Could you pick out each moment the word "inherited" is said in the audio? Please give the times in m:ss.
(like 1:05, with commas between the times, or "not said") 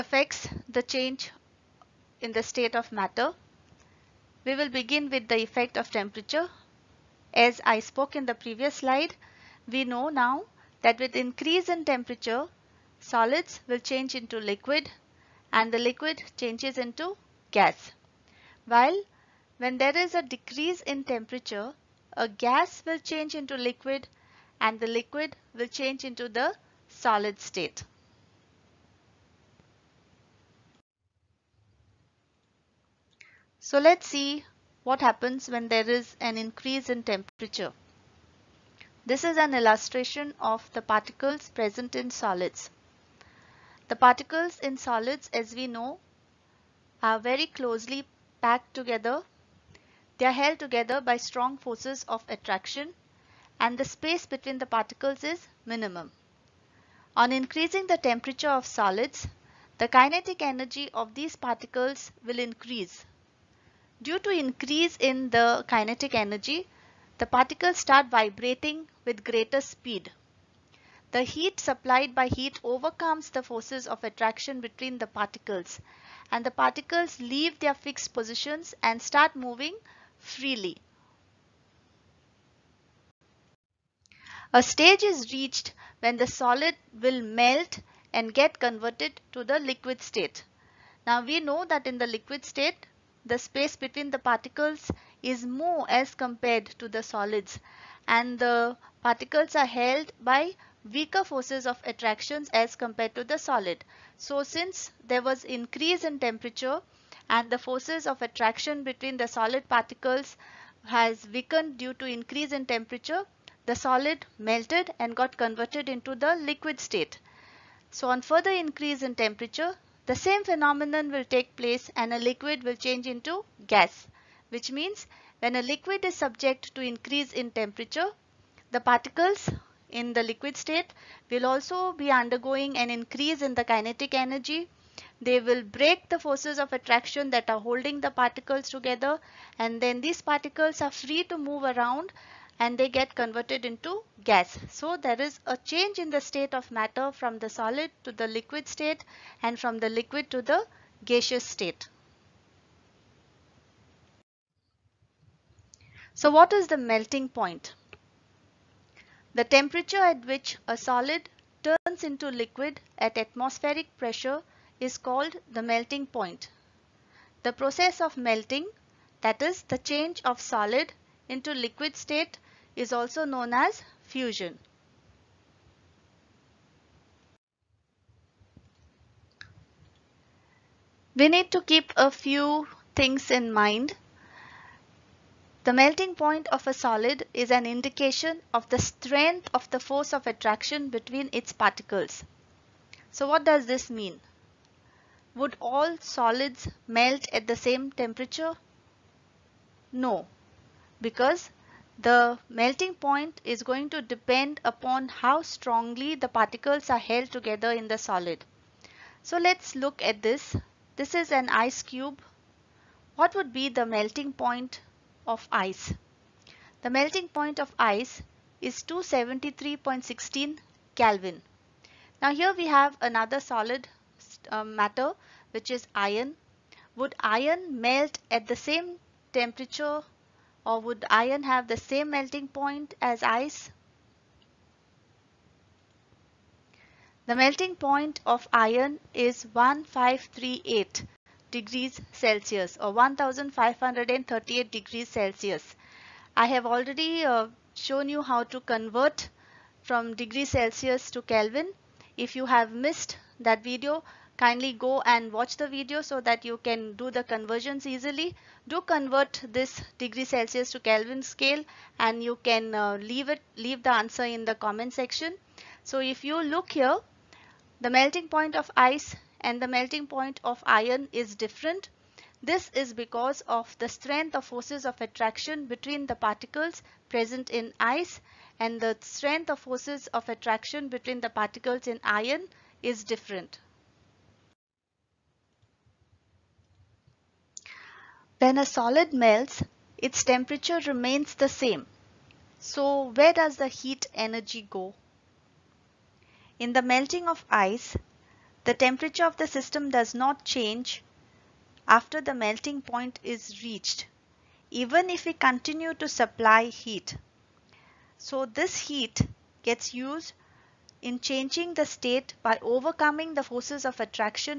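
not said.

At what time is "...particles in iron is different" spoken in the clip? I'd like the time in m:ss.
4:41.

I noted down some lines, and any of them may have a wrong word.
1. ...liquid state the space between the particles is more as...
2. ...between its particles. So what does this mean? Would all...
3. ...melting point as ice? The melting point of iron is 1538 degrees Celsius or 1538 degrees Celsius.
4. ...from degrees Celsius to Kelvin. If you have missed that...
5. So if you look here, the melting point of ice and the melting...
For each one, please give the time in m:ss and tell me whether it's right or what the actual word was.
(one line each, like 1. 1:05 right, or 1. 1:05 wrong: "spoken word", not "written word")
1. 1:32 right
2. 3:10 right
3. 3:52 right
4. 4:09 right
5. 4:25 right.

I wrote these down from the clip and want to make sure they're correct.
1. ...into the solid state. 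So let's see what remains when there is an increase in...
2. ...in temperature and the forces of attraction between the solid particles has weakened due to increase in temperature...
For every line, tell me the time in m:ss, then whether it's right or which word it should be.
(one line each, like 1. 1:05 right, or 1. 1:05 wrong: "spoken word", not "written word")
1. 0:26 wrong: "happens", not "remains"
2. 1:46 right.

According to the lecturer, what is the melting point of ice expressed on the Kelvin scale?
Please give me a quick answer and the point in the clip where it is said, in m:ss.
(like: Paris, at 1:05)
273.16 Kelvin, at 3:38.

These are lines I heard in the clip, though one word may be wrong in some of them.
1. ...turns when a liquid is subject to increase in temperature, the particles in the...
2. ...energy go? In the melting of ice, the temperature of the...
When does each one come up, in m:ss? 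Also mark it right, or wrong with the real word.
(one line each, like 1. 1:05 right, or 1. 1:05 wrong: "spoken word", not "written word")
1. 2:04 wrong: "means", not "turns"
2. 4:54 right.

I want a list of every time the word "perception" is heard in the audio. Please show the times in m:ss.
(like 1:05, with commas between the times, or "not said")
not said.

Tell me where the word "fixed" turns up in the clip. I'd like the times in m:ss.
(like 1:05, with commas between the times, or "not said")
1:17.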